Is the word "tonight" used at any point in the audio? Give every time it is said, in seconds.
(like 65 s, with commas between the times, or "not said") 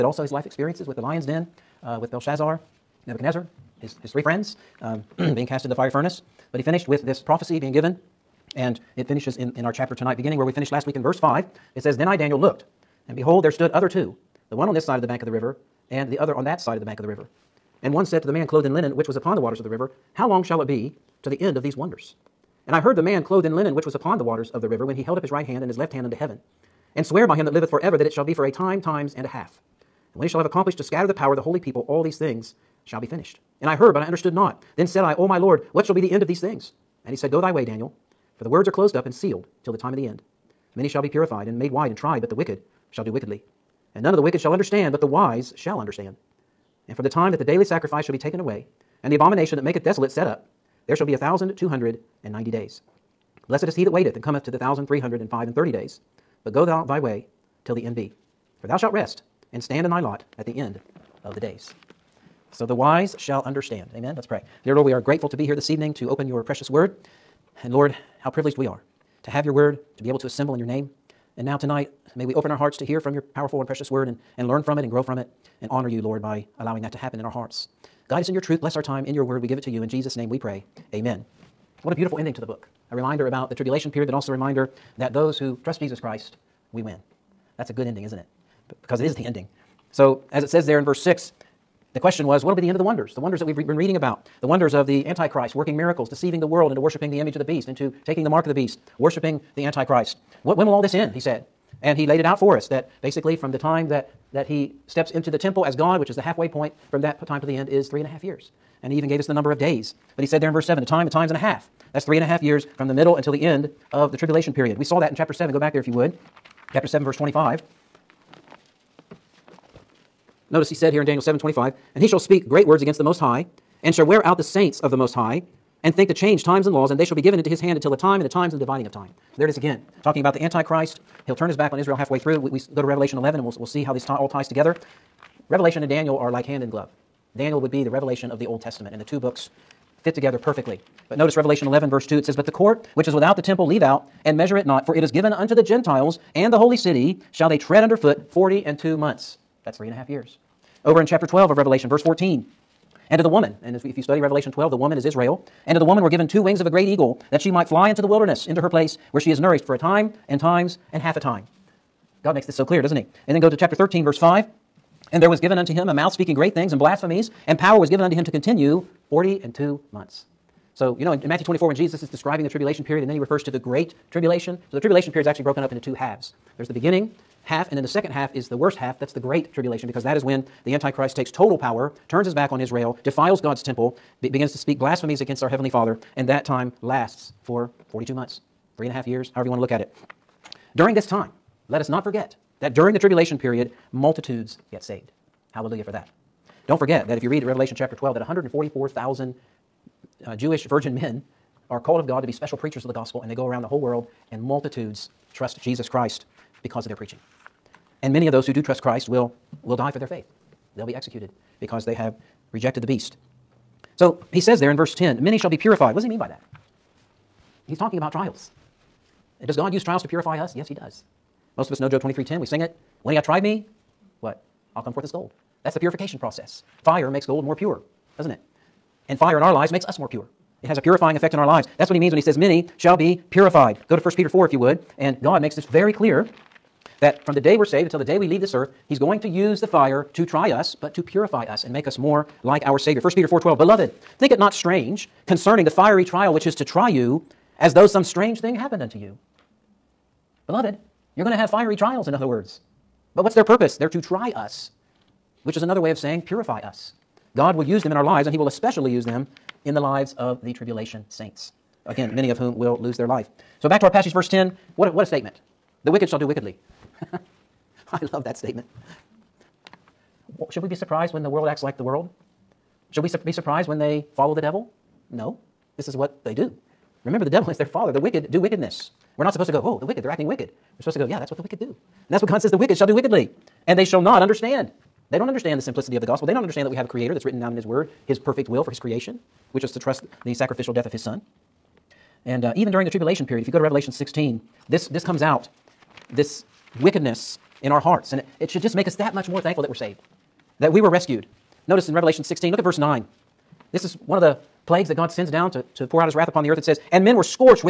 9 s, 71 s.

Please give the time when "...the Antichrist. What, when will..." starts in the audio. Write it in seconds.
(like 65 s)
99 s.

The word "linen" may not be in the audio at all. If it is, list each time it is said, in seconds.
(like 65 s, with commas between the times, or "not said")
18 s, 23 s.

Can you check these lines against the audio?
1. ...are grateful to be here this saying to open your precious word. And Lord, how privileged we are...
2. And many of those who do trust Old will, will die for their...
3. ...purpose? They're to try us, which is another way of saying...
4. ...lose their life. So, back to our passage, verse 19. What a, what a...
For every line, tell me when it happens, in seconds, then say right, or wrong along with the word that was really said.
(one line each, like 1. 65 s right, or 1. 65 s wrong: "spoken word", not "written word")
1. 64 s wrong: "evening", not "saying"
2. 208 s wrong: "Christ", not "Old"
3. 253 s right
4. 262 s wrong: "10", not "19".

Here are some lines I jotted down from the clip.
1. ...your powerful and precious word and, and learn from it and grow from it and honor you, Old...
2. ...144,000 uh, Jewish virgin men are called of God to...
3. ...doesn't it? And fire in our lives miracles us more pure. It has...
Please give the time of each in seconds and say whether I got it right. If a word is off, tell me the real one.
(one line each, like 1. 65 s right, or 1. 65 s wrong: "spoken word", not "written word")
1. 73 s wrong: "Lord", not "Old"
2. 198 s right
3. 228 s wrong: "makes", not "miracles".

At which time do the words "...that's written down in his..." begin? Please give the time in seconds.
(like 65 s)
287 s.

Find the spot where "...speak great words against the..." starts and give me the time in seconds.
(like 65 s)
122 s.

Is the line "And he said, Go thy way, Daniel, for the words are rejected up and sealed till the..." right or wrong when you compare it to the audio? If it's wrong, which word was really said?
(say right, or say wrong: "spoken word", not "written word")
wrong: "closed", not "rejected".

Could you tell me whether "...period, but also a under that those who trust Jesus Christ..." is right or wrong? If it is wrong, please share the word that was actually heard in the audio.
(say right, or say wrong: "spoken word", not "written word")
wrong: "reminder", not "under".